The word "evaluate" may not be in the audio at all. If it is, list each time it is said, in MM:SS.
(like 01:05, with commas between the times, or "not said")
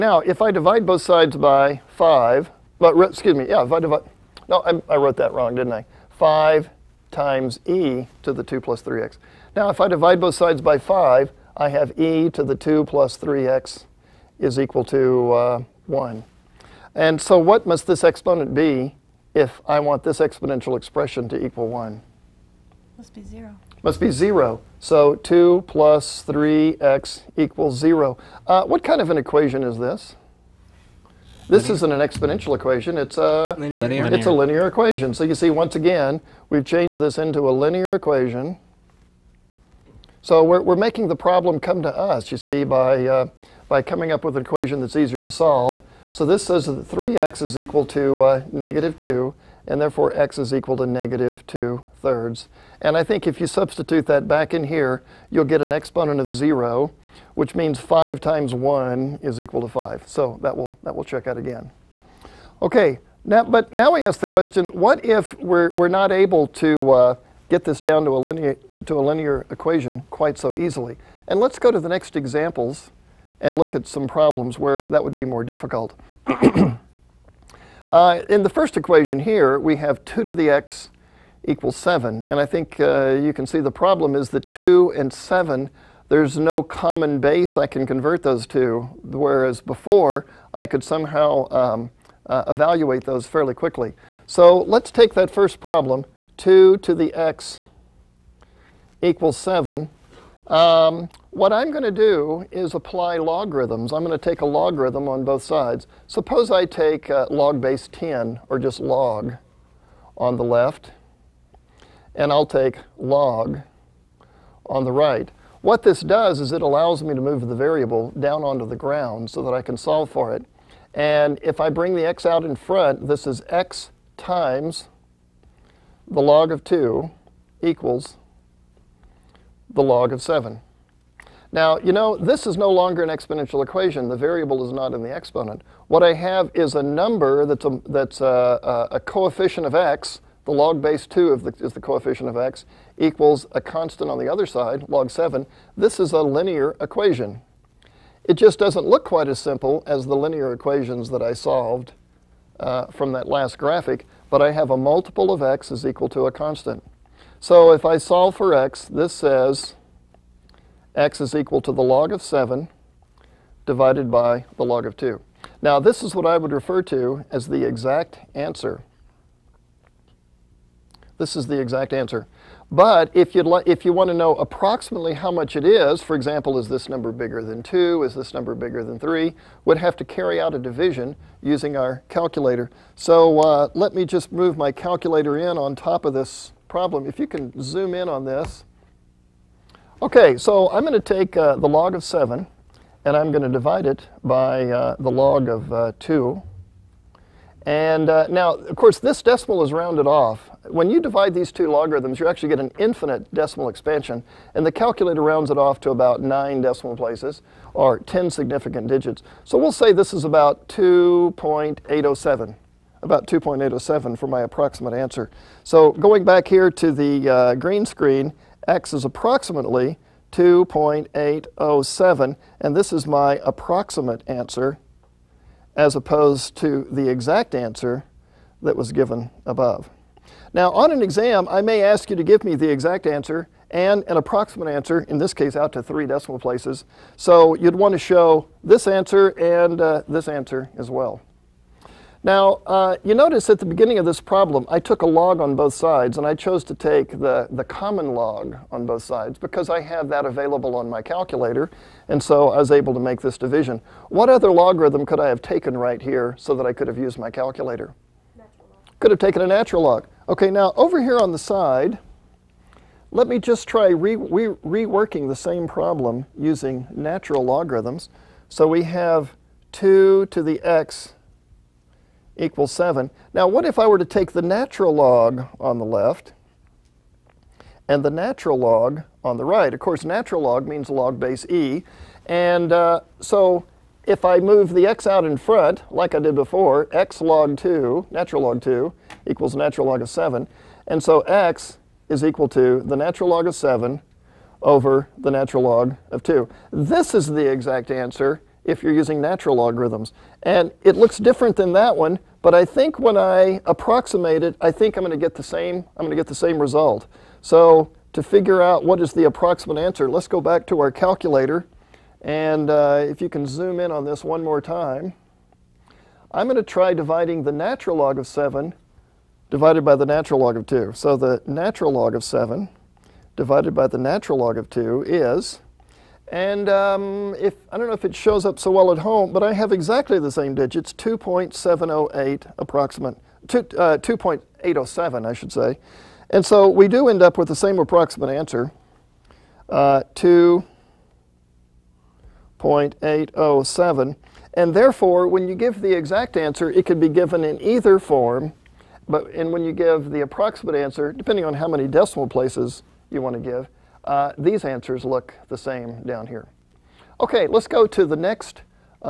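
01:32.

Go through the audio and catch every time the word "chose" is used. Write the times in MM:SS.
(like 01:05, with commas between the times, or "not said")
04:06.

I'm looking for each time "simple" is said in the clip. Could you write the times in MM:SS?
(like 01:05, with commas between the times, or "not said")
02:29.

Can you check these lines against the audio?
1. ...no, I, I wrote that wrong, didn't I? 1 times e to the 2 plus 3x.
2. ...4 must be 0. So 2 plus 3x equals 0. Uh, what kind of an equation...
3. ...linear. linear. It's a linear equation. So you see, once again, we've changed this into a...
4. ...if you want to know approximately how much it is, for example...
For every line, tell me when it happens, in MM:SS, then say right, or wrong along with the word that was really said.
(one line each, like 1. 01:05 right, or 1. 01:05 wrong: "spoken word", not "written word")
1. 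00:04 wrong: "5", not "1"
2. 00:23 wrong: "0", not "4"
3. 00:33 right
4. 02:53 right.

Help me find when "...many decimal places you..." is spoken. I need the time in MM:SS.
05:51.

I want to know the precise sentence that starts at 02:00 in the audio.
And if I bring the x out in front, this is x times the log of 2 equals the log of 7.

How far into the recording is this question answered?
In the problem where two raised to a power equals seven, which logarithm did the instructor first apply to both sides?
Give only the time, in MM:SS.
01:47.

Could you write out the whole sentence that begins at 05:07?
So to figure out what is the approximate answer, let's go back to our calculator.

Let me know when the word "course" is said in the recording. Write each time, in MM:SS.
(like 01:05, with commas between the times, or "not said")
03:18, 04:39.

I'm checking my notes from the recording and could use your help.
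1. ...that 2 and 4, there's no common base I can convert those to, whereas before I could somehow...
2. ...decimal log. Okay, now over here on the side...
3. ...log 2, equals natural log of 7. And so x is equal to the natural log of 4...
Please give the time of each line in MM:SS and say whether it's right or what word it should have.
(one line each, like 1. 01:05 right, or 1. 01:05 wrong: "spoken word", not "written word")
1. 01:24 wrong: "7", not "4"
2. 04:19 wrong: "natural", not "decimal"
3. 04:48 wrong: "7", not "4".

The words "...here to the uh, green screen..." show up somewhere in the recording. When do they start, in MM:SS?
03:36.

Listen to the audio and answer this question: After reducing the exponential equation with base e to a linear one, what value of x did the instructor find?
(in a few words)
-2/3.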